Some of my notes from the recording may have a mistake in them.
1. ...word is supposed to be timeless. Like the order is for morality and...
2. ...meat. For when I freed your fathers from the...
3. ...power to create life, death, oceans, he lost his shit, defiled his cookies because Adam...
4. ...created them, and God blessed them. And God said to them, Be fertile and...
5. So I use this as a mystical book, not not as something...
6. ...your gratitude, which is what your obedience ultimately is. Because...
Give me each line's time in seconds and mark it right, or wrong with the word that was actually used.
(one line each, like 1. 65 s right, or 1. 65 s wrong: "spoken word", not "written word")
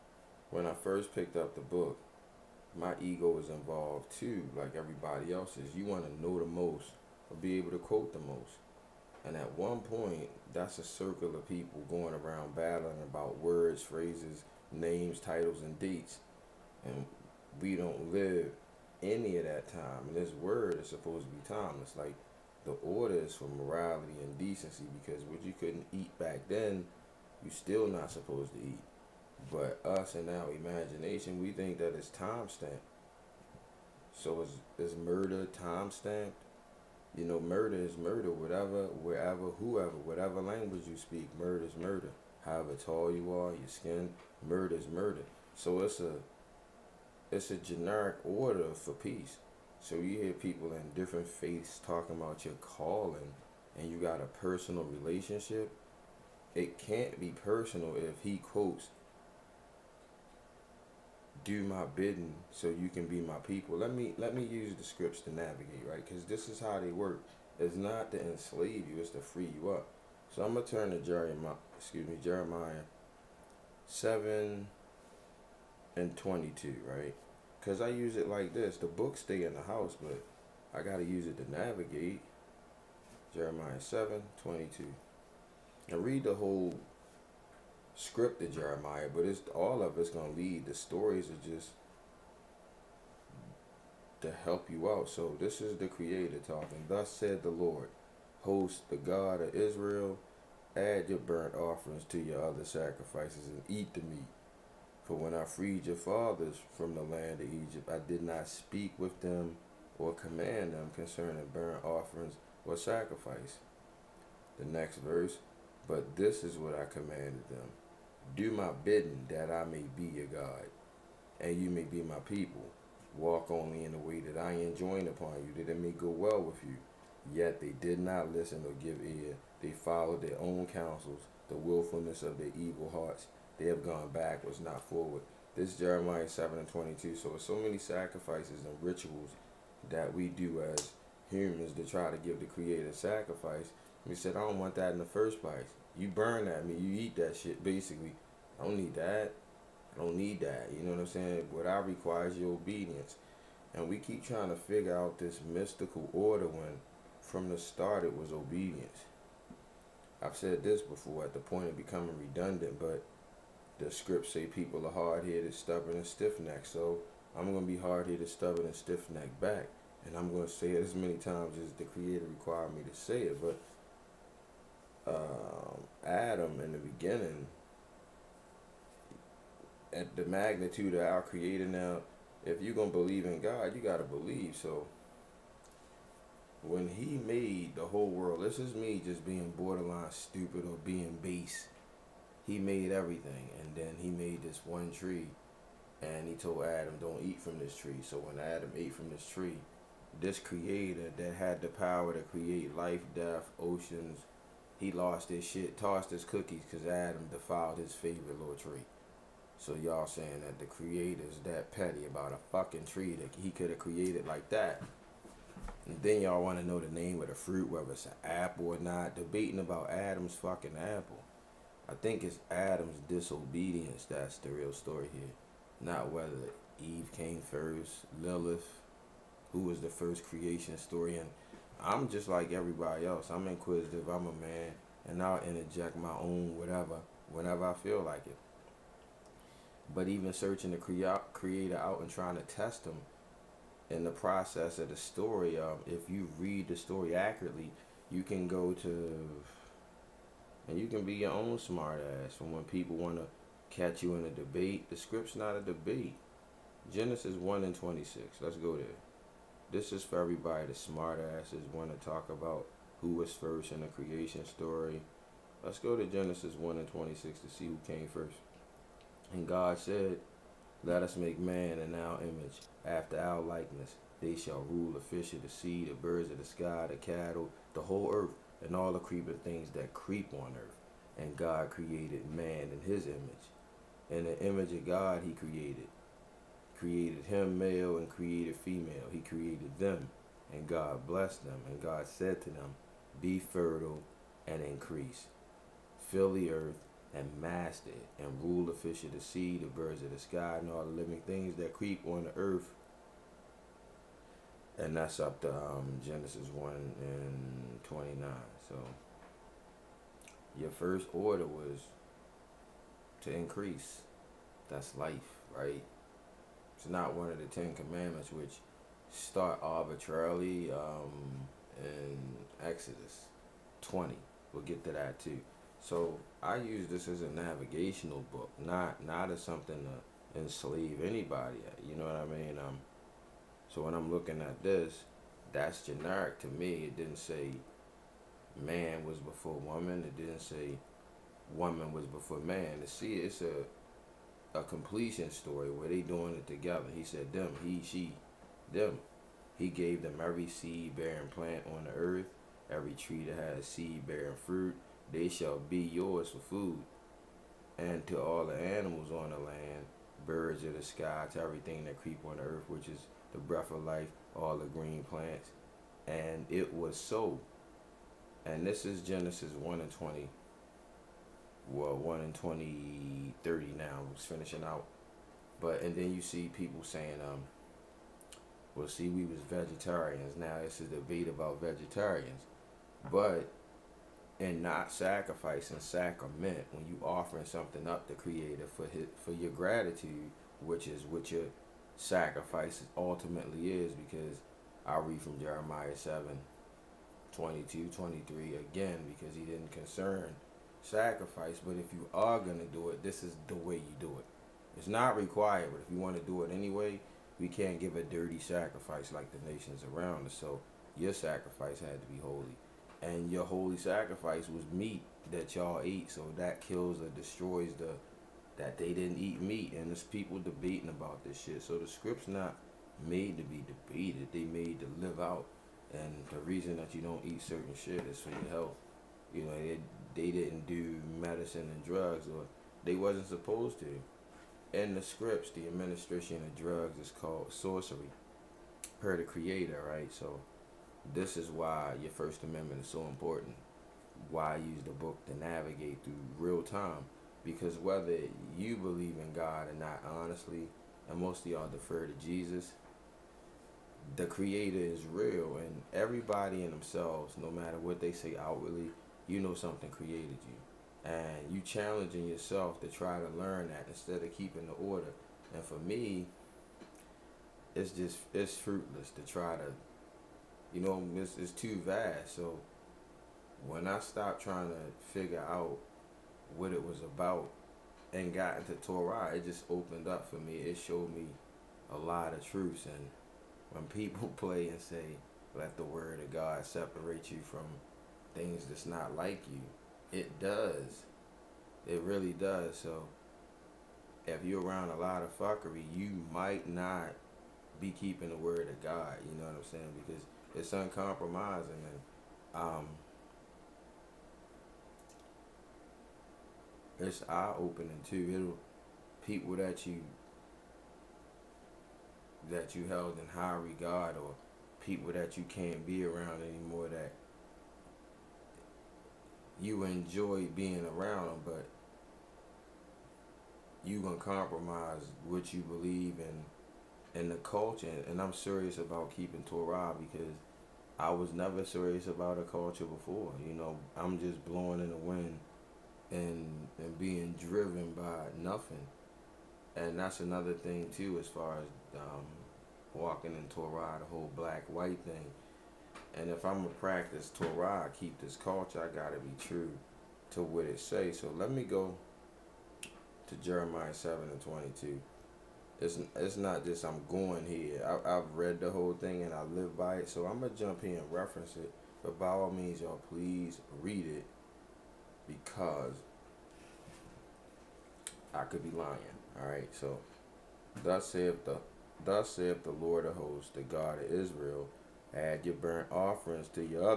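1. 20 s right
2. 104 s right
3. 201 s wrong: "tossed", not "defiled"
4. 289 s right
5. 325 s wrong: "navigational", not "mystical"
6. 389 s wrong: "sacrifice", not "obedience".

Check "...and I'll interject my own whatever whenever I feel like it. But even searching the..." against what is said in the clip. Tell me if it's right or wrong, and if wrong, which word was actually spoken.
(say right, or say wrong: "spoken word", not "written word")
right.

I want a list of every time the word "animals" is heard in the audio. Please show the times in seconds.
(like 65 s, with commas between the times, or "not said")
358 s.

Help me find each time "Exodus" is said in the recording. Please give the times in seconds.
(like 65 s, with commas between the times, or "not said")
322 s.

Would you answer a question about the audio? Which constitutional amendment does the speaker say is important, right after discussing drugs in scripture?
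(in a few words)
First Amendment.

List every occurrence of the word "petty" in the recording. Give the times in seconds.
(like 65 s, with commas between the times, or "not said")
211 s.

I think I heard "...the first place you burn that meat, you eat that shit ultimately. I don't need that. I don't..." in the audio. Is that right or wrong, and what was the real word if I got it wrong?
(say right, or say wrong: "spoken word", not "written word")
wrong: "basically", not "ultimately".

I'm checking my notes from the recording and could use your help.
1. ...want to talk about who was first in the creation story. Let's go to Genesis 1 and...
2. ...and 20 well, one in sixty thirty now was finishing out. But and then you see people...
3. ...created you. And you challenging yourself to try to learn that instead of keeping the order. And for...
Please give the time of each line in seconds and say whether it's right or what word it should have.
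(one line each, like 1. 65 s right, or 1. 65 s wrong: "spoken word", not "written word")
1. 261 s right
2. 369 s wrong: "twenty", not "sixty"
3. 459 s right.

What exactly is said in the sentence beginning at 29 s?
But us and our imagination, we think that it's time stamped.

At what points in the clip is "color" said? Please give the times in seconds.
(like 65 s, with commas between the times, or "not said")
not said.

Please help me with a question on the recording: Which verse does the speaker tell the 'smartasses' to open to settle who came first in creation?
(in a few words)
Genesis 1:26.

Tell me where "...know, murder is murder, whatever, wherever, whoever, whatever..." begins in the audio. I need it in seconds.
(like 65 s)
37 s.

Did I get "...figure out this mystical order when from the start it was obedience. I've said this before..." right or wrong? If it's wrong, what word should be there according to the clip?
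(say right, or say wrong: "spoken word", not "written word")
right.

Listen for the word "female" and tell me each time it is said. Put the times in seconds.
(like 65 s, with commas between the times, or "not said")
288 s.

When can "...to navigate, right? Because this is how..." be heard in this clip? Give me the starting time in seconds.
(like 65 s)
65 s.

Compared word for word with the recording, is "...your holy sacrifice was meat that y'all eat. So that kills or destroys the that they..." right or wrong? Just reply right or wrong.
right.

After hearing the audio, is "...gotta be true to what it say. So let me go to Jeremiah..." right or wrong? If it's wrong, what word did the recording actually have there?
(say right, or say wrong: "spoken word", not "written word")
right.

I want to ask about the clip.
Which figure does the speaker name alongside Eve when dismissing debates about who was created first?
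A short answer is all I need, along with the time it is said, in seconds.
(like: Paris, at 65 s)
Lilith, at 228 s.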